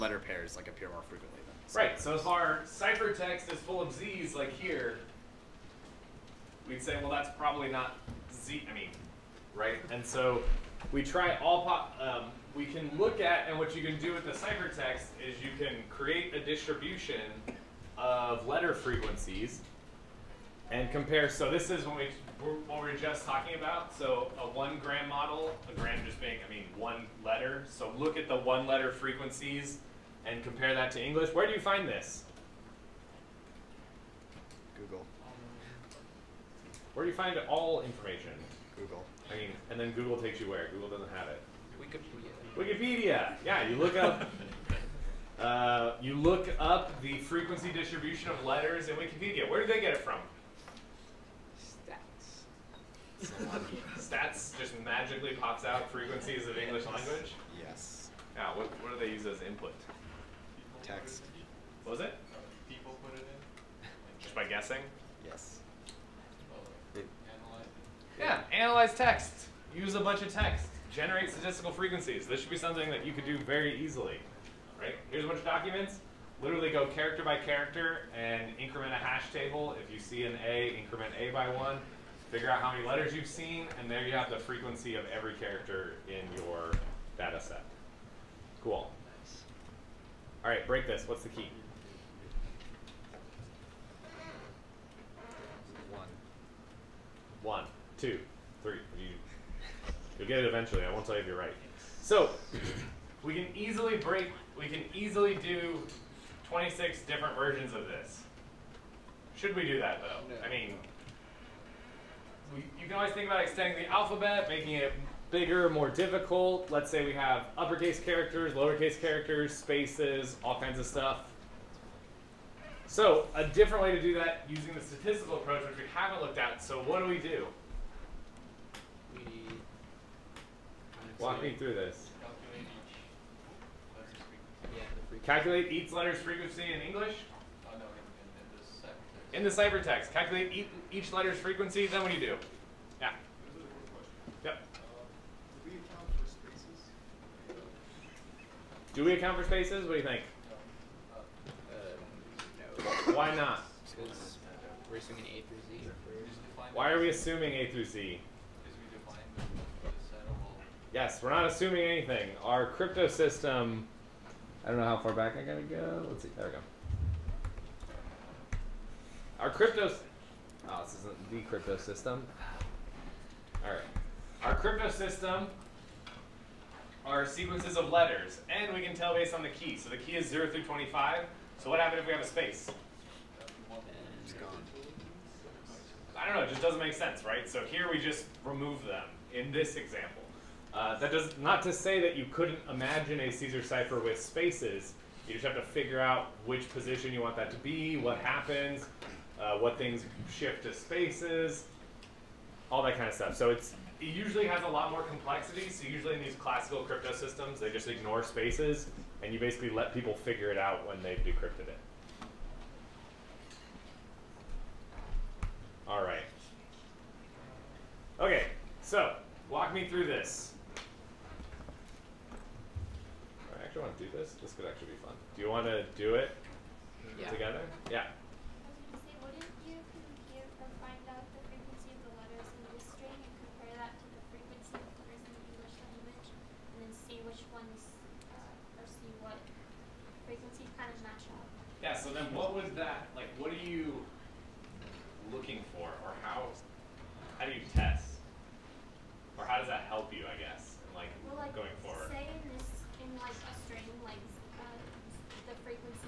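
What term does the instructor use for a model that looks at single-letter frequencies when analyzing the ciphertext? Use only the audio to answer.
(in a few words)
One gram model.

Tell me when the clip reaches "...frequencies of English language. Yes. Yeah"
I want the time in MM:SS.
00:55.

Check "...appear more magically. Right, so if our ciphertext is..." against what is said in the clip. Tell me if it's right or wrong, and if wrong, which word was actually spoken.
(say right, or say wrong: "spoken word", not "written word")
wrong: "frequently", not "magically".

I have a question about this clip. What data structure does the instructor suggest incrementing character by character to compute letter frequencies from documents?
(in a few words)
Hash table.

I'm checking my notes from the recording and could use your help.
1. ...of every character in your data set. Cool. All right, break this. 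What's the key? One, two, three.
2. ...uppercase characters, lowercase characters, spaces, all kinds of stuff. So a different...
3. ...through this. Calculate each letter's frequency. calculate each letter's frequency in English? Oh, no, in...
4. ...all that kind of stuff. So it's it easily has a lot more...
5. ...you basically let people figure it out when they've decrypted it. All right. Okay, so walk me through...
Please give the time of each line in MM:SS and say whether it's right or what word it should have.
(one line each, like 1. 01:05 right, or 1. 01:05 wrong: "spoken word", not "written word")
1. 01:24 right
2. 01:57 right
3. 02:11 right
4. 03:22 wrong: "usually", not "easily"
5. 03:29 right.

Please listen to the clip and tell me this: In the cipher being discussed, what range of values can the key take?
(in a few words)
0 through 25.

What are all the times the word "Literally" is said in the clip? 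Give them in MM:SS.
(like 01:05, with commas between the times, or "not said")
01:16.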